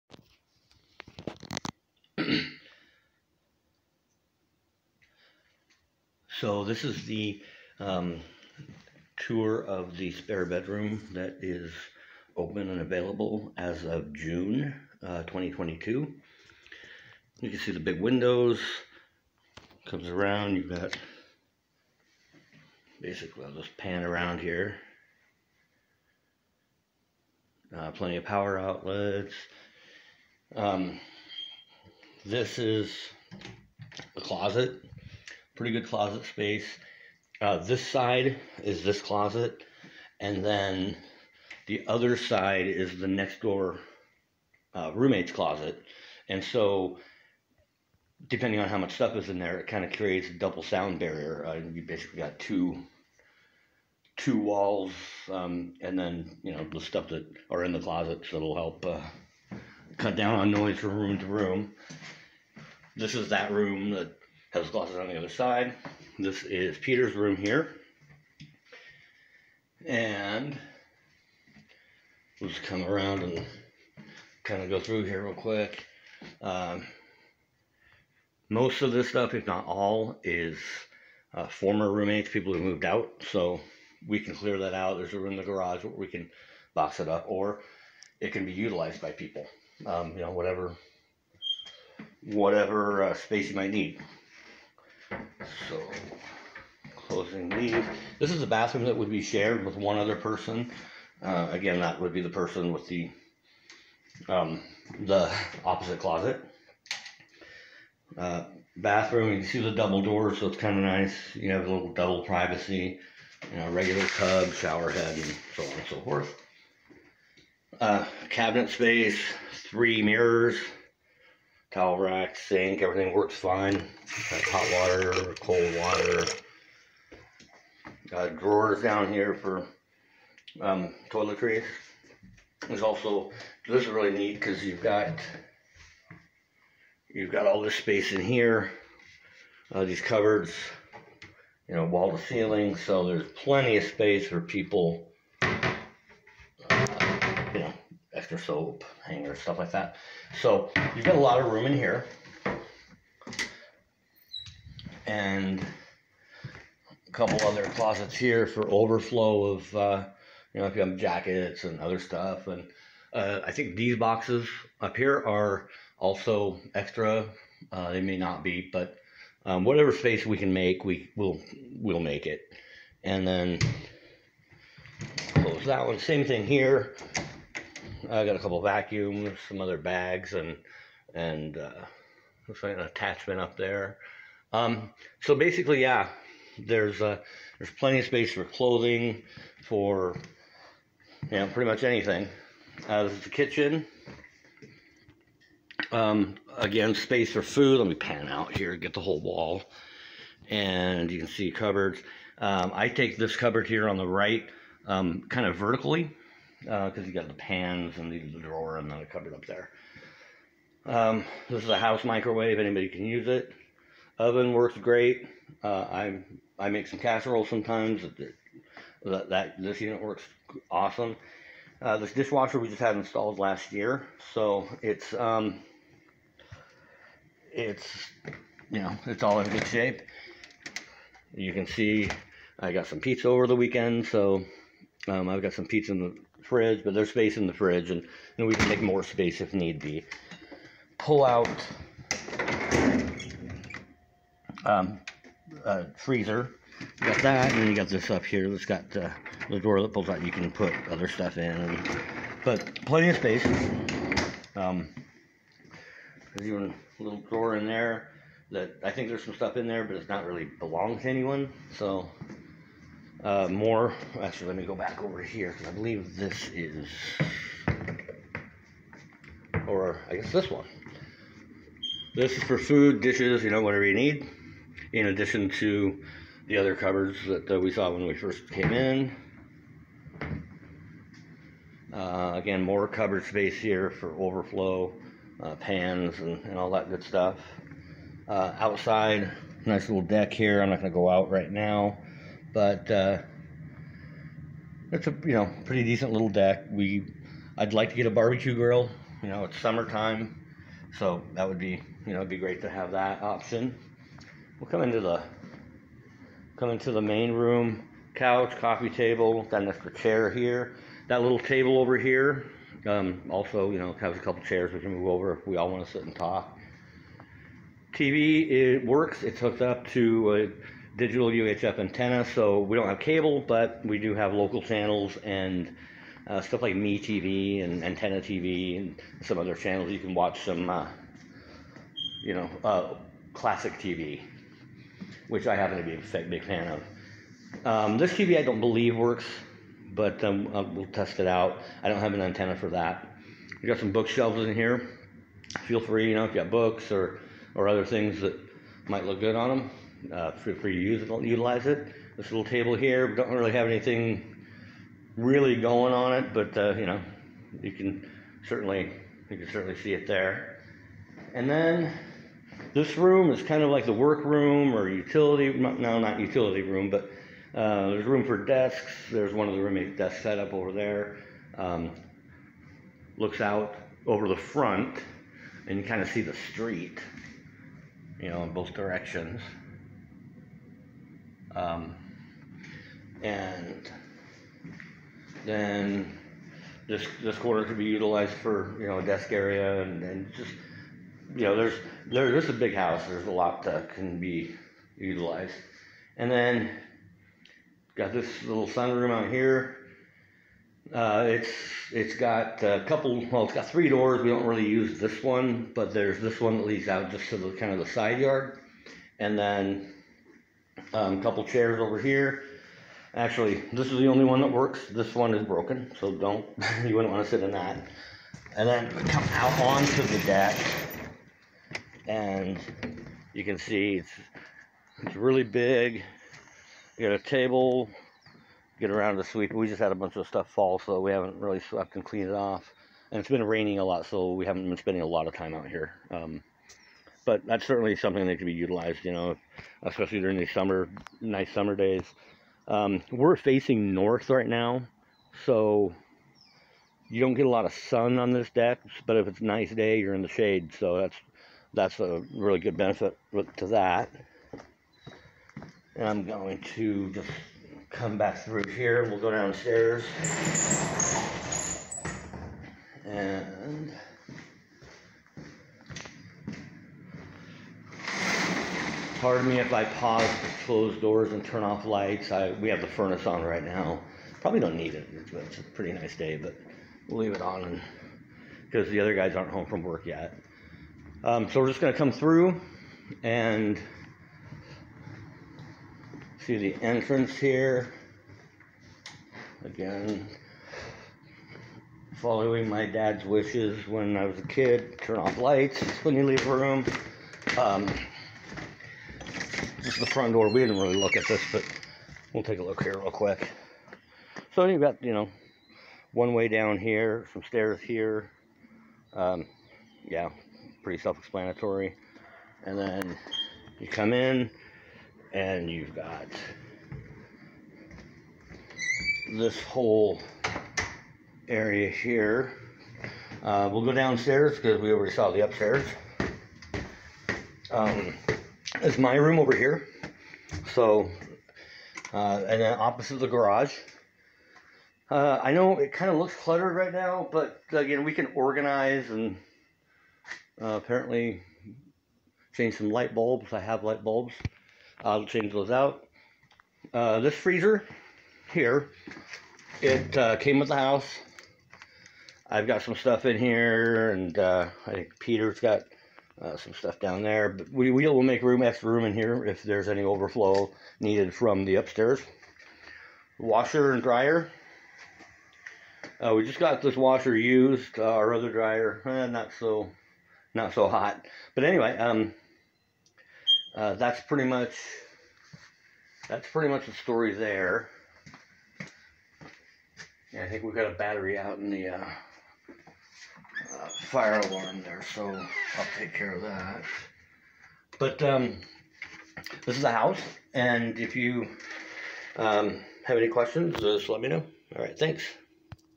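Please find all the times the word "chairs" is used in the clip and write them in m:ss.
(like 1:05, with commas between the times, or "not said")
5:10, 5:14, 6:51.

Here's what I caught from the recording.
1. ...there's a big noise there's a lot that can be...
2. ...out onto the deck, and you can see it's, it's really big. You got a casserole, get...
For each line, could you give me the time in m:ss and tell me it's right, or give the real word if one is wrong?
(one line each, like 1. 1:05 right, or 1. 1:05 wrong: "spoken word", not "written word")
1. 6:32 wrong: "house", not "noise"
2. 6:59 wrong: "table", not "casserole".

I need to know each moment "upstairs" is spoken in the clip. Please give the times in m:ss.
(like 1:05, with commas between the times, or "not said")
8:45, 9:21.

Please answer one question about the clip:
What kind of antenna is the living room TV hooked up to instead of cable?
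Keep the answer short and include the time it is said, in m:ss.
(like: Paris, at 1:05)
Digital UHF antenna, at 5:20.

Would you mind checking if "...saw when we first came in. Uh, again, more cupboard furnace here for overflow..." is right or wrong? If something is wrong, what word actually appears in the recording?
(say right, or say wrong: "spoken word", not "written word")
wrong: "space", not "furnace".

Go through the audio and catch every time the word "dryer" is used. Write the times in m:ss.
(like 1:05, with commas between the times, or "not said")
9:24, 9:28.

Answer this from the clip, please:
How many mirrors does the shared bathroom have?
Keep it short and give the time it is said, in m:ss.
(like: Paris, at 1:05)
3, at 1:59.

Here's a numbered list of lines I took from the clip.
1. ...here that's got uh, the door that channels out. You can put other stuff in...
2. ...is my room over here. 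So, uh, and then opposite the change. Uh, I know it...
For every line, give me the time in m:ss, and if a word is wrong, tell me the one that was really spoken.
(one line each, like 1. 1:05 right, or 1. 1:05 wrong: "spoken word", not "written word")
1. 4:08 wrong: "pulls", not "channels"
2. 8:48 wrong: "garage", not "change".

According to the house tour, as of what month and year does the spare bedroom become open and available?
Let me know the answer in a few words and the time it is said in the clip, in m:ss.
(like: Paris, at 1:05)
June 2022, at 0:14.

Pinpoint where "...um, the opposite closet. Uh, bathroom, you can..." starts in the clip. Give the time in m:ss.
1:44.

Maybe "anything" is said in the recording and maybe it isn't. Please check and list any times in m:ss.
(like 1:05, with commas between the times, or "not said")
3:11, 5:53.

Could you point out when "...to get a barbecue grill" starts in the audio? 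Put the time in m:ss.
4:57.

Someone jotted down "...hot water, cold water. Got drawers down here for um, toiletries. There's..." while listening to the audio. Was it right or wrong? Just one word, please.
right.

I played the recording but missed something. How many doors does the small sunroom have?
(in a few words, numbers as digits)
3.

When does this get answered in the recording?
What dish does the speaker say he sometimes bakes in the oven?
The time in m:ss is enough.
3:36.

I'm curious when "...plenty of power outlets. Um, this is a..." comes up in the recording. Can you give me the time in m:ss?
0:27.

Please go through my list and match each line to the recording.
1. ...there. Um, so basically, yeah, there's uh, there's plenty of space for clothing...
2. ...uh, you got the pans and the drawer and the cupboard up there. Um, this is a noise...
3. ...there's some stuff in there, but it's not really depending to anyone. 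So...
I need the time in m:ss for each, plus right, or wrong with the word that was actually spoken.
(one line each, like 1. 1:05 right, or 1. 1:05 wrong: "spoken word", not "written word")
1. 3:03 right
2. 3:26 wrong: "house", not "noise"
3. 4:19 wrong: "belong", not "depending".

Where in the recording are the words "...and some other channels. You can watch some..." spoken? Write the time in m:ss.
5:28.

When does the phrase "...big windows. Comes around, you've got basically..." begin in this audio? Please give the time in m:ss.
0:17.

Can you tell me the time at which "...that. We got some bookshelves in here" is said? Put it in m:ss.
5:42.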